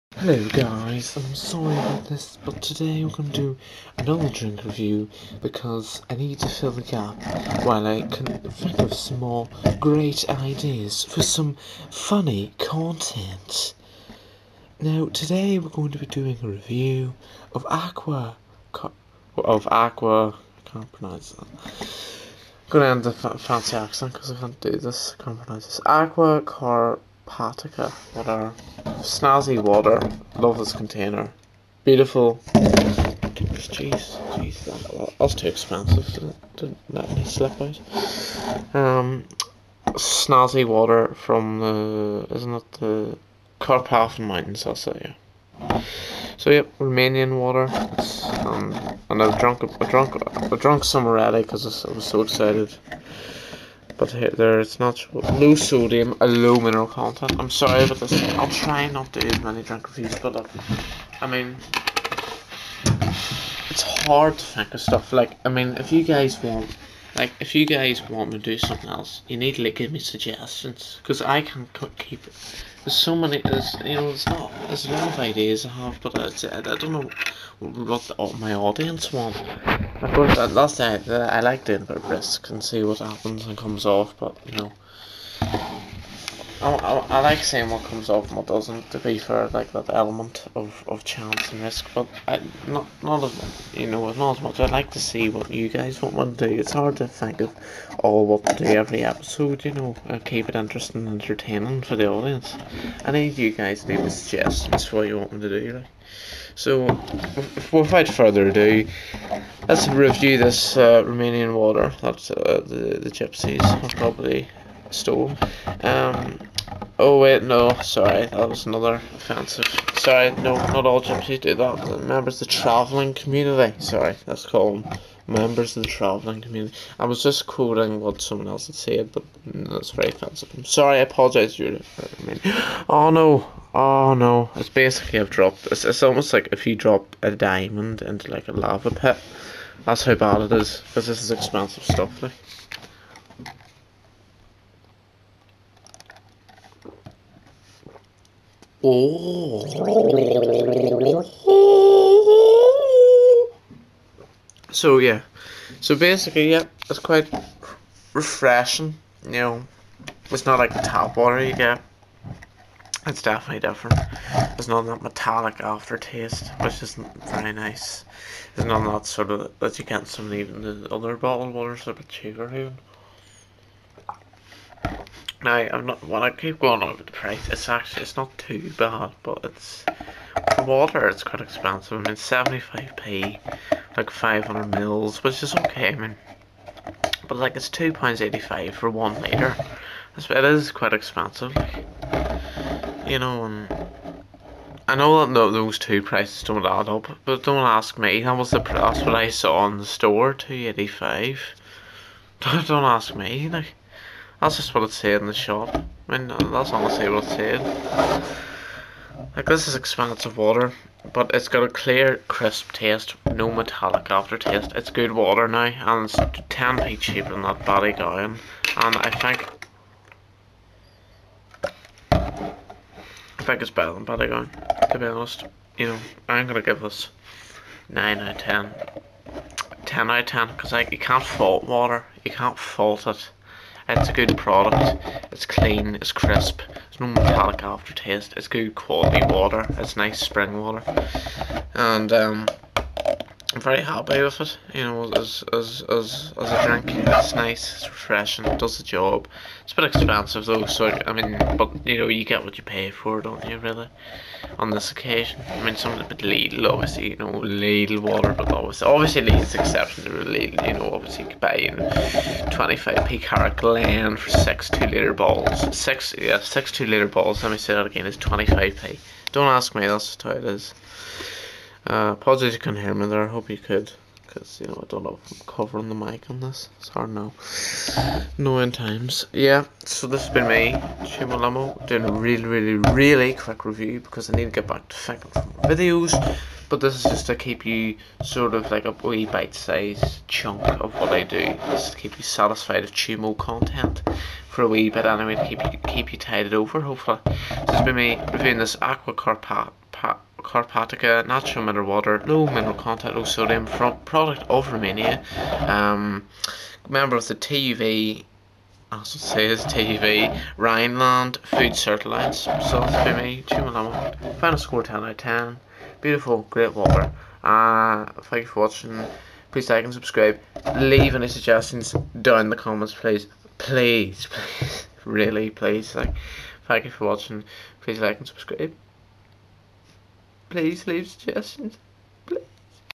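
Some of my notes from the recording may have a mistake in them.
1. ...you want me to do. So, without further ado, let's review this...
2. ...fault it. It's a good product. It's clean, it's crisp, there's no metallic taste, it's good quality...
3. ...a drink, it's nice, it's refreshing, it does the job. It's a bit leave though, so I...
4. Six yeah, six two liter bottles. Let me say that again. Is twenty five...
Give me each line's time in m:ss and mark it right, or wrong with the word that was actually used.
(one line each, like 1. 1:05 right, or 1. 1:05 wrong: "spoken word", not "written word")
1. 1:45 right
2. 3:52 wrong: "aftertaste", not "taste"
3. 4:06 wrong: "expensive", not "leave"
4. 4:25 right.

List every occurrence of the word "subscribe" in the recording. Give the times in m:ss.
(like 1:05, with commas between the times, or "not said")
5:19, 5:28.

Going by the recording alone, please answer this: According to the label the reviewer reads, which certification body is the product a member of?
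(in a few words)
TUV Rheinland.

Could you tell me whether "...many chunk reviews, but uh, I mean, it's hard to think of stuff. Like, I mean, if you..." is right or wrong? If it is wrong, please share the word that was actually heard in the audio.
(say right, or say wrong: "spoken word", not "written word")
wrong: "drink", not "chunk".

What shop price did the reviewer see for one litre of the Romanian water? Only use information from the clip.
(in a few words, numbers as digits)
£2.85.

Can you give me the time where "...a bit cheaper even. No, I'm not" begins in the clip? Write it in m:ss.
2:51.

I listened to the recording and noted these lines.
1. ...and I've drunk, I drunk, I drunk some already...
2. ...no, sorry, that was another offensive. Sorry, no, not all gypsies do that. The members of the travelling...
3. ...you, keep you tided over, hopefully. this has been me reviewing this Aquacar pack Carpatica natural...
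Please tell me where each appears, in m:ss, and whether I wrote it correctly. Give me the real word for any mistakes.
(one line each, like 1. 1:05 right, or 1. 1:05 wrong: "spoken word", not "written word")
1. 0:49 right
2. 1:57 right
3. 4:55 right.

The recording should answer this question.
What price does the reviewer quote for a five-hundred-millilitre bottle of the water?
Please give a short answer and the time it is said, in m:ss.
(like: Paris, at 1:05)
75p, at 3:02.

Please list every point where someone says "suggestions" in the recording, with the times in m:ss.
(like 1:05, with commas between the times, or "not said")
1:09, 1:44, 5:21, 5:31.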